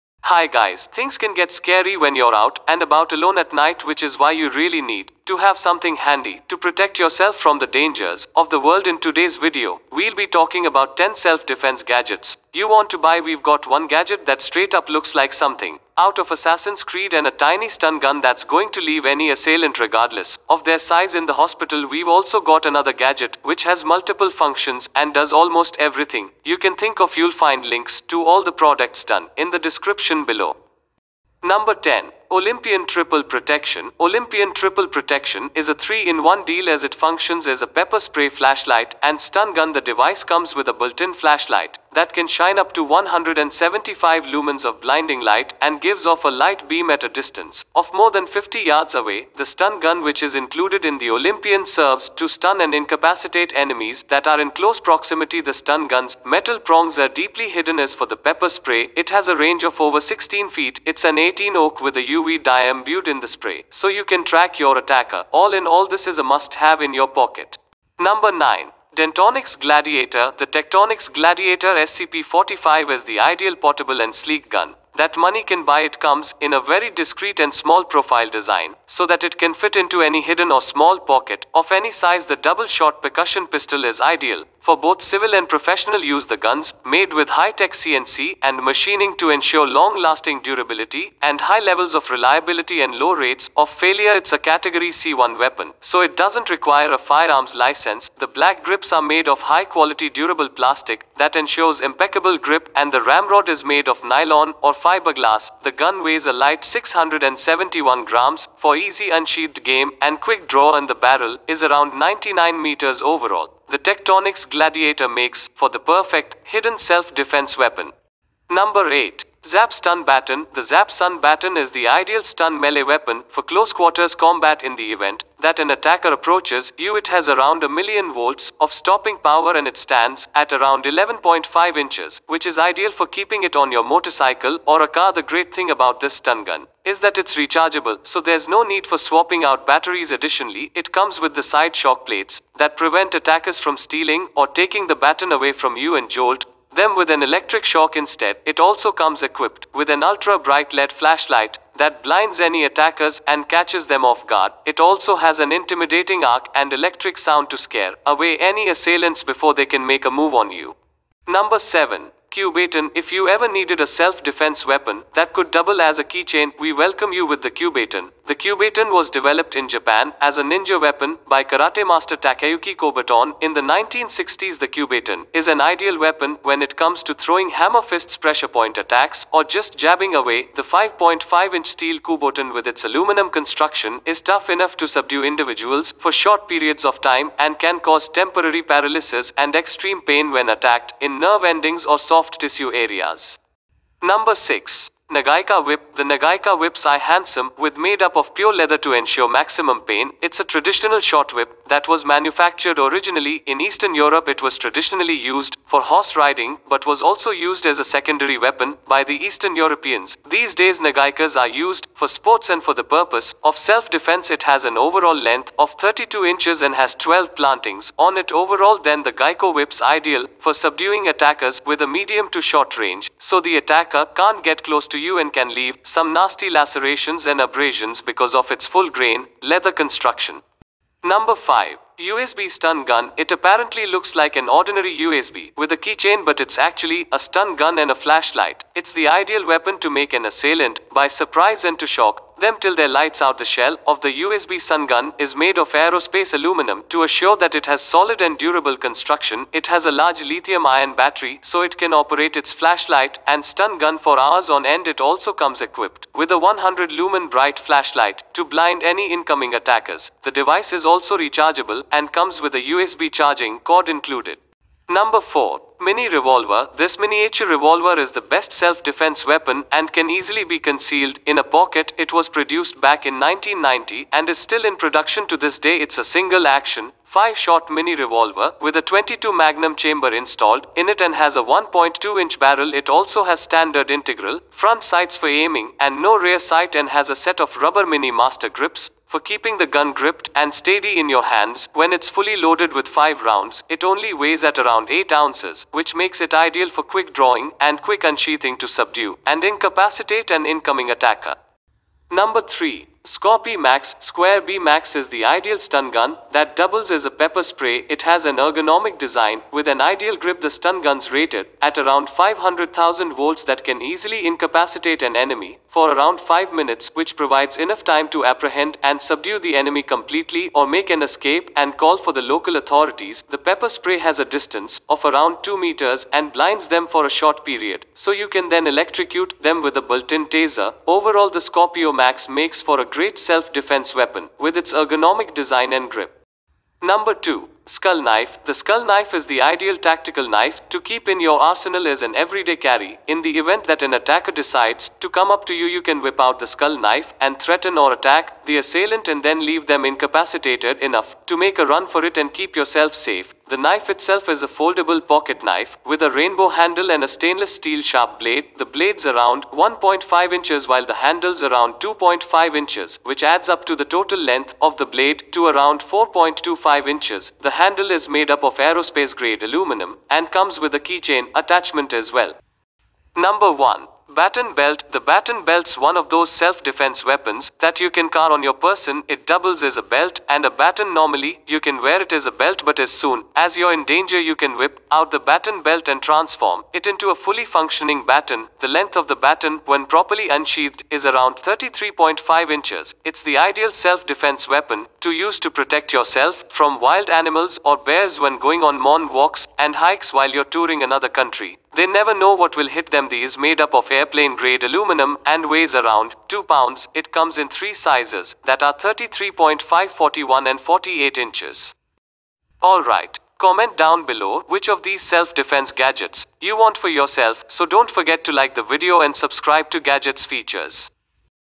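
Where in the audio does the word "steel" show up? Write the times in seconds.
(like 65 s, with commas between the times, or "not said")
181 s, 357 s.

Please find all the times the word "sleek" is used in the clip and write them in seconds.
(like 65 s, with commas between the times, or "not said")
74 s.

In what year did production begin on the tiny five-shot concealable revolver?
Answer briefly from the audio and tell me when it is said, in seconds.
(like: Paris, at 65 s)
1990, at 273 s.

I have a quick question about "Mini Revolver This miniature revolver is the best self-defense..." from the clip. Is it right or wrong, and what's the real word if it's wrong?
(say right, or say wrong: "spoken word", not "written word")
right.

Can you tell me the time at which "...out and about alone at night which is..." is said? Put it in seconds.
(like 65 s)
2 s.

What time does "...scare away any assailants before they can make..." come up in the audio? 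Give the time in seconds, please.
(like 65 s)
157 s.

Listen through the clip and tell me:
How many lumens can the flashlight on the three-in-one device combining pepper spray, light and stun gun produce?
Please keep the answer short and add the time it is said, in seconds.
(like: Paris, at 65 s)
175, at 42 s.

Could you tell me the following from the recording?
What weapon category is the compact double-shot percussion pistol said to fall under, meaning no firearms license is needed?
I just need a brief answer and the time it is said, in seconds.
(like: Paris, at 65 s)
Category C1, at 94 s.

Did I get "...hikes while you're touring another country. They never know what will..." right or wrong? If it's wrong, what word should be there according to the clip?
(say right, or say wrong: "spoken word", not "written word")
right.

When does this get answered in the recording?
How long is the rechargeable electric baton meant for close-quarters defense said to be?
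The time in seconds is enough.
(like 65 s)
130 s.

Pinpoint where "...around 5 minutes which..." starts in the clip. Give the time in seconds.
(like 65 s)
315 s.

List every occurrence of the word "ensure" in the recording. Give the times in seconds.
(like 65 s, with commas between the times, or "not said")
89 s, 101 s, 198 s.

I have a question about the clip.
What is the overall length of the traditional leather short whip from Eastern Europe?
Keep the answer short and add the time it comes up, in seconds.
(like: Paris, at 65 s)
32 inches, at 215 s.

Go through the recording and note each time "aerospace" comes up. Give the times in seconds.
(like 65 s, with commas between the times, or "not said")
245 s, 368 s.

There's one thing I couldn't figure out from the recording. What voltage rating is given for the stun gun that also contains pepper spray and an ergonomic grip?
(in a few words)
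500,000 volts.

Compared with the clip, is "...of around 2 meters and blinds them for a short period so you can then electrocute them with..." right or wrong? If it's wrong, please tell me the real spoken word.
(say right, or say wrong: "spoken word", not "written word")
right.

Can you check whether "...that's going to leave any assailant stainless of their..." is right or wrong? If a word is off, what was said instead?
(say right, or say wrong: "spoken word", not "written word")
wrong: "regardless", not "stainless".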